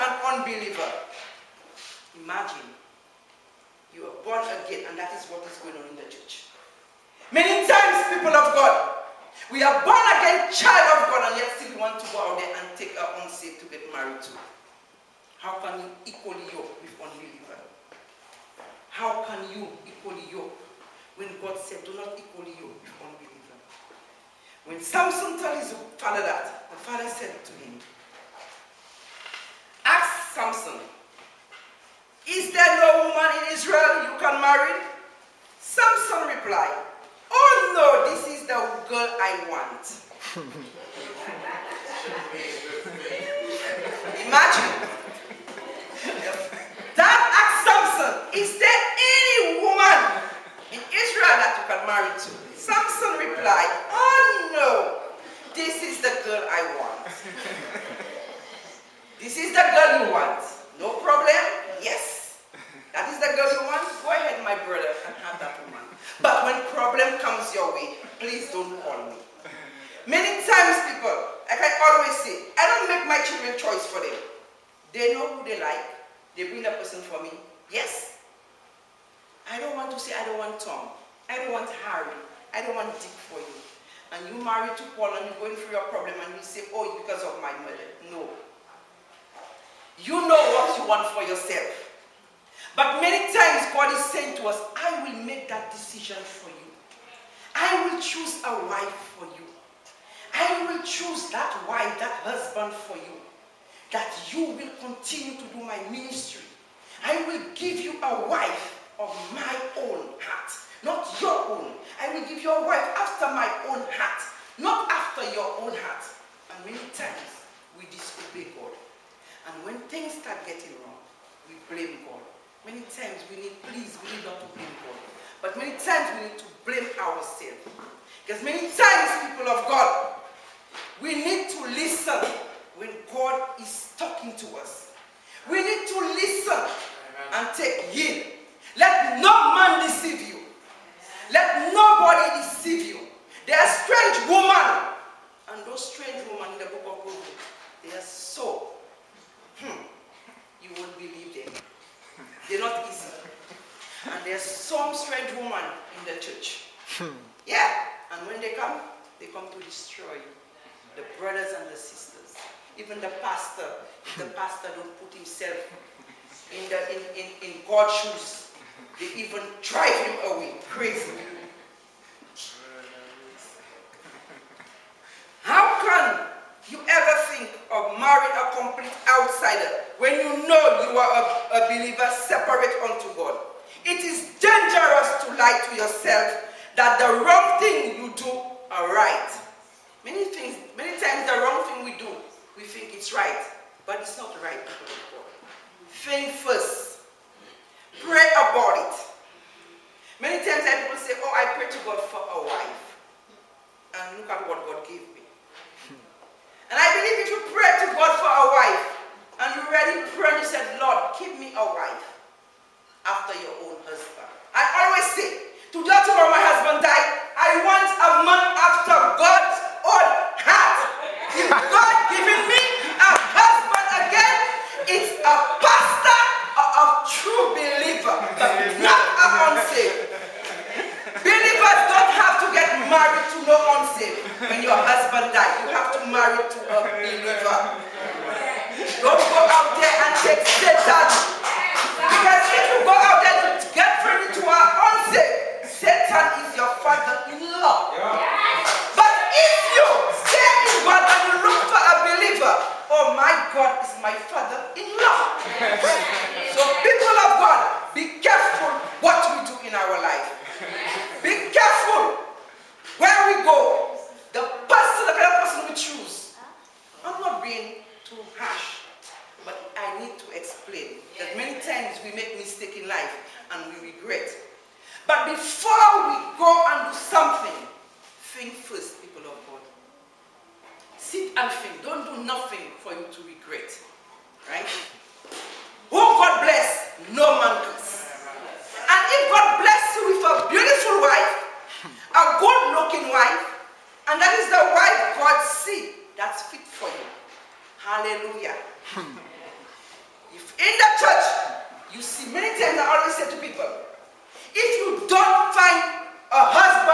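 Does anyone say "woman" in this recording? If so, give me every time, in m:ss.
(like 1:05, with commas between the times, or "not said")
0:33, 0:49, 1:05, 2:35.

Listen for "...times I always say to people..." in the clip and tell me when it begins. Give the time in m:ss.
5:02.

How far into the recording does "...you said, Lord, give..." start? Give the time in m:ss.
3:30.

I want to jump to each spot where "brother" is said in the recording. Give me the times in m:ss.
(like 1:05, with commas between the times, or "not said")
1:04, 2:41.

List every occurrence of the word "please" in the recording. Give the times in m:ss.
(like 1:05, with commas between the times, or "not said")
1:08, 2:03.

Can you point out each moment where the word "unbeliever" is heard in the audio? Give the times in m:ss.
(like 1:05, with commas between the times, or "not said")
0:00, 0:16, 0:22.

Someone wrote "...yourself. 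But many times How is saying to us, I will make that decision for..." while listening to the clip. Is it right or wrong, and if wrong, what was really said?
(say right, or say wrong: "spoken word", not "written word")
wrong: "God", not "How".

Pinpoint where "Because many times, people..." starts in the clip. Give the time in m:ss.
2:08.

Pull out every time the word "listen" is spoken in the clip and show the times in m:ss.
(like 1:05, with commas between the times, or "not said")
2:11, 2:16.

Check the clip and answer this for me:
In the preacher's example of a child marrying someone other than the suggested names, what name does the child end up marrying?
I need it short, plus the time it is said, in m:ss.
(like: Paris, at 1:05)
Paul, at 1:24.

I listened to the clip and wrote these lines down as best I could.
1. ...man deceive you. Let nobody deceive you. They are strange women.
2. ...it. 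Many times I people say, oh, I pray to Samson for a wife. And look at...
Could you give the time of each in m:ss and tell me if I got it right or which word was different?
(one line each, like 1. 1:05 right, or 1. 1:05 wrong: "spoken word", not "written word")
1. 2:19 right
2. 3:18 wrong: "God", not "Samson".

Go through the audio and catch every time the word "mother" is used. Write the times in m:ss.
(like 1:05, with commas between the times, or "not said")
1:27.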